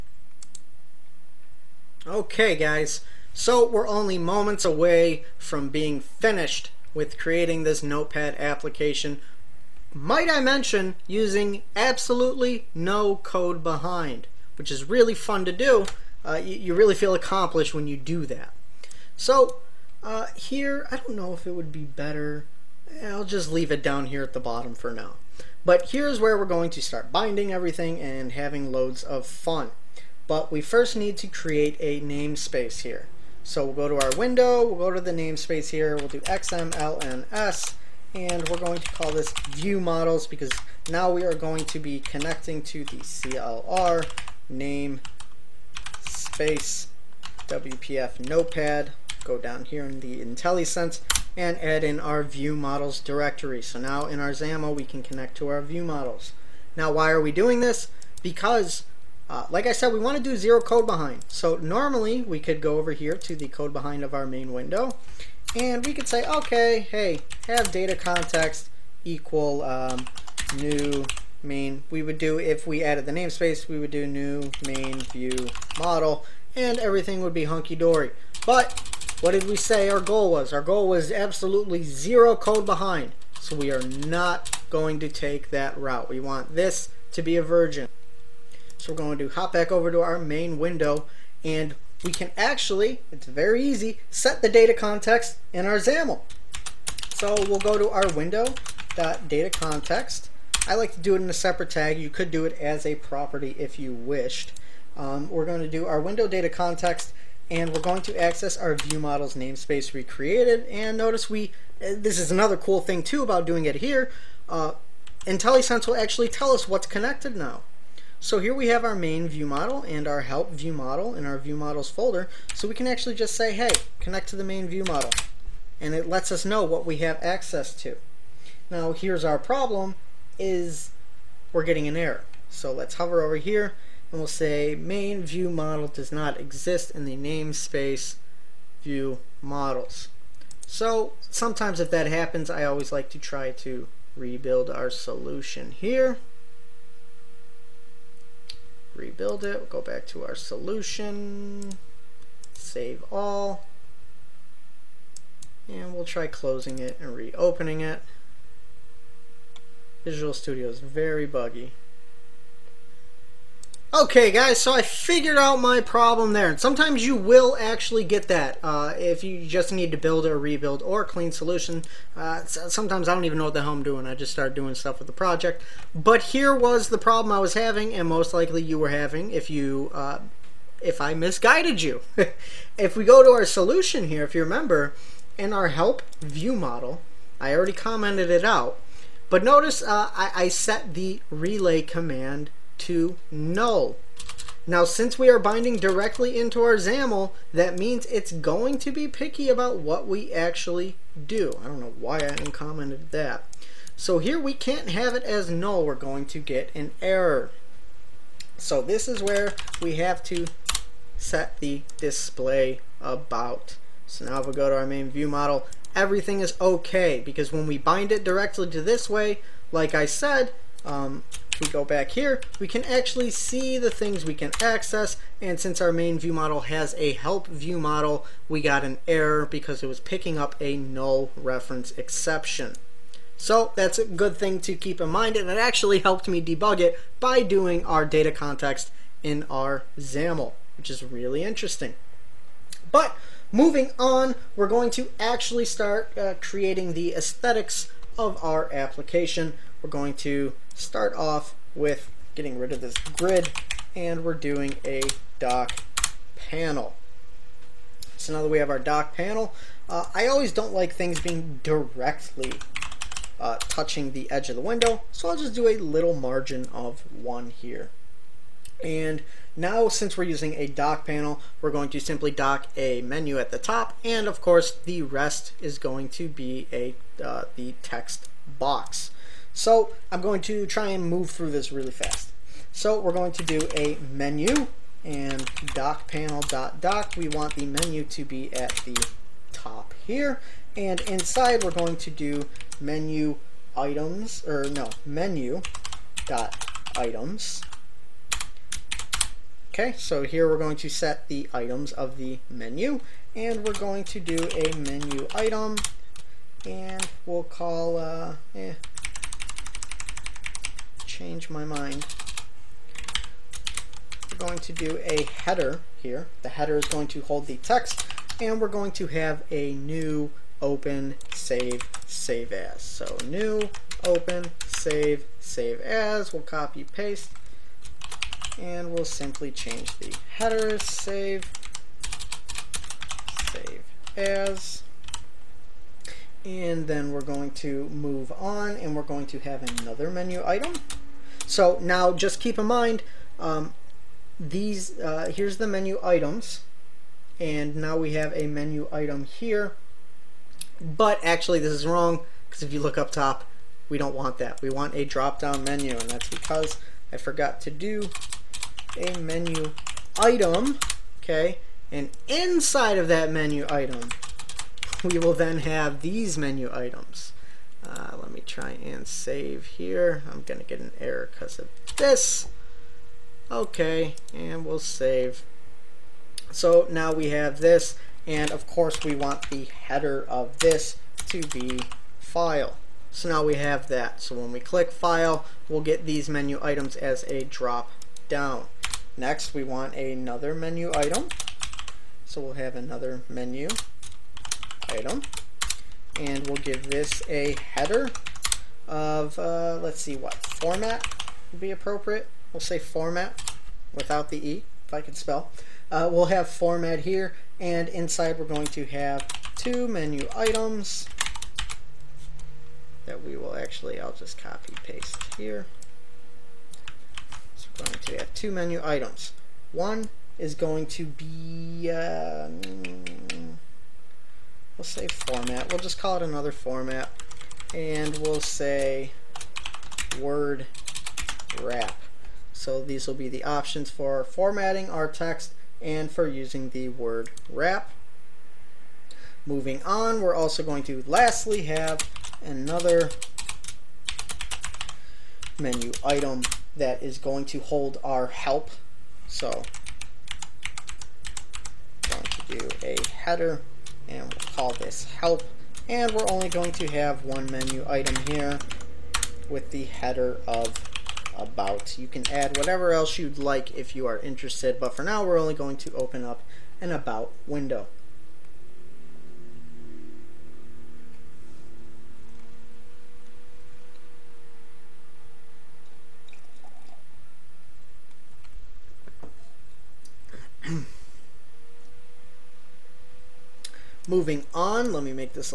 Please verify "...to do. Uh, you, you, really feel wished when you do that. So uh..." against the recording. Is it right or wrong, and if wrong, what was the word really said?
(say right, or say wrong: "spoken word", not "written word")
wrong: "accomplished", not "wished".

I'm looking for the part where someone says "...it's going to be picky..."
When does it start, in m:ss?
3:18.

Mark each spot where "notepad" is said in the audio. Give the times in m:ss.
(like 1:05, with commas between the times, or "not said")
0:07, 0:48.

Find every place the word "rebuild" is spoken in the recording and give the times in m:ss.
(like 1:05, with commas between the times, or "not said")
2:24, 2:28, 2:50.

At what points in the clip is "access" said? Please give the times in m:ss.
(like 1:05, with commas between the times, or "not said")
1:48, 2:07, 3:44.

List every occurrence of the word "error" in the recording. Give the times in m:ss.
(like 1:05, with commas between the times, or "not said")
2:11, 3:27, 3:49, 6:10.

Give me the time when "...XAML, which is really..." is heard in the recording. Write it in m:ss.
3:59.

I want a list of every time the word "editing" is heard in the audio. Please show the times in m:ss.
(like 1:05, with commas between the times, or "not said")
not said.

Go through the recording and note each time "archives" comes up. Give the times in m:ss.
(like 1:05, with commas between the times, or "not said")
not said.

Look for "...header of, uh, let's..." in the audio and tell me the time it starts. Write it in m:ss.
6:37.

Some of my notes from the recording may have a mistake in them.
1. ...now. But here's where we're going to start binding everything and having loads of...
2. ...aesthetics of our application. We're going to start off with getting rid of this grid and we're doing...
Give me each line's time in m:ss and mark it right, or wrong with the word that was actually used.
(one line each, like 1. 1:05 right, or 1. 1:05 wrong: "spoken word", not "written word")
1. 0:24 right
2. 4:07 right.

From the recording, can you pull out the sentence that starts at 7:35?
And we're only going to have one menu item here with the header of about.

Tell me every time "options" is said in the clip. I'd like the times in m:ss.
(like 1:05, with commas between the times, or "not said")
7:13.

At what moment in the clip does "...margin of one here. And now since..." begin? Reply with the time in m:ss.
4:26.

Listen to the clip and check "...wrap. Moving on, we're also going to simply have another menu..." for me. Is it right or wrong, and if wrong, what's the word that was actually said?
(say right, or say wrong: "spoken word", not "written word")
wrong: "lastly", not "simply".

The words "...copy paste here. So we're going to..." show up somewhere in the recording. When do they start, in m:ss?
6:54.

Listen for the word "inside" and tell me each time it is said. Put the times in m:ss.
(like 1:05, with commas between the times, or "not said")
4:51, 6:02, 6:47.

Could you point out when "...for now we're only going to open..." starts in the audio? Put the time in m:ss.
7:44.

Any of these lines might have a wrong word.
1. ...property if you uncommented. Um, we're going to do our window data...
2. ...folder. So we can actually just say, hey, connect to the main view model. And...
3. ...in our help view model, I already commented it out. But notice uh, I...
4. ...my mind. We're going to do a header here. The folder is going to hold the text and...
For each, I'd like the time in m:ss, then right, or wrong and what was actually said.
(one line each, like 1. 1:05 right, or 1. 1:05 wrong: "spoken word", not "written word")
1. 1:42 wrong: "wished", not "uncommented"
2. 2:01 right
3. 3:05 right
4. 5:11 wrong: "header", not "folder".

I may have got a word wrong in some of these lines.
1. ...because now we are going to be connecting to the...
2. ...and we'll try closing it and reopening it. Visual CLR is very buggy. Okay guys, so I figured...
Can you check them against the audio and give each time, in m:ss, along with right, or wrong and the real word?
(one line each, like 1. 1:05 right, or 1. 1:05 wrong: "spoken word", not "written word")
1. 0:40 right
2. 2:35 wrong: "Studio", not "CLR".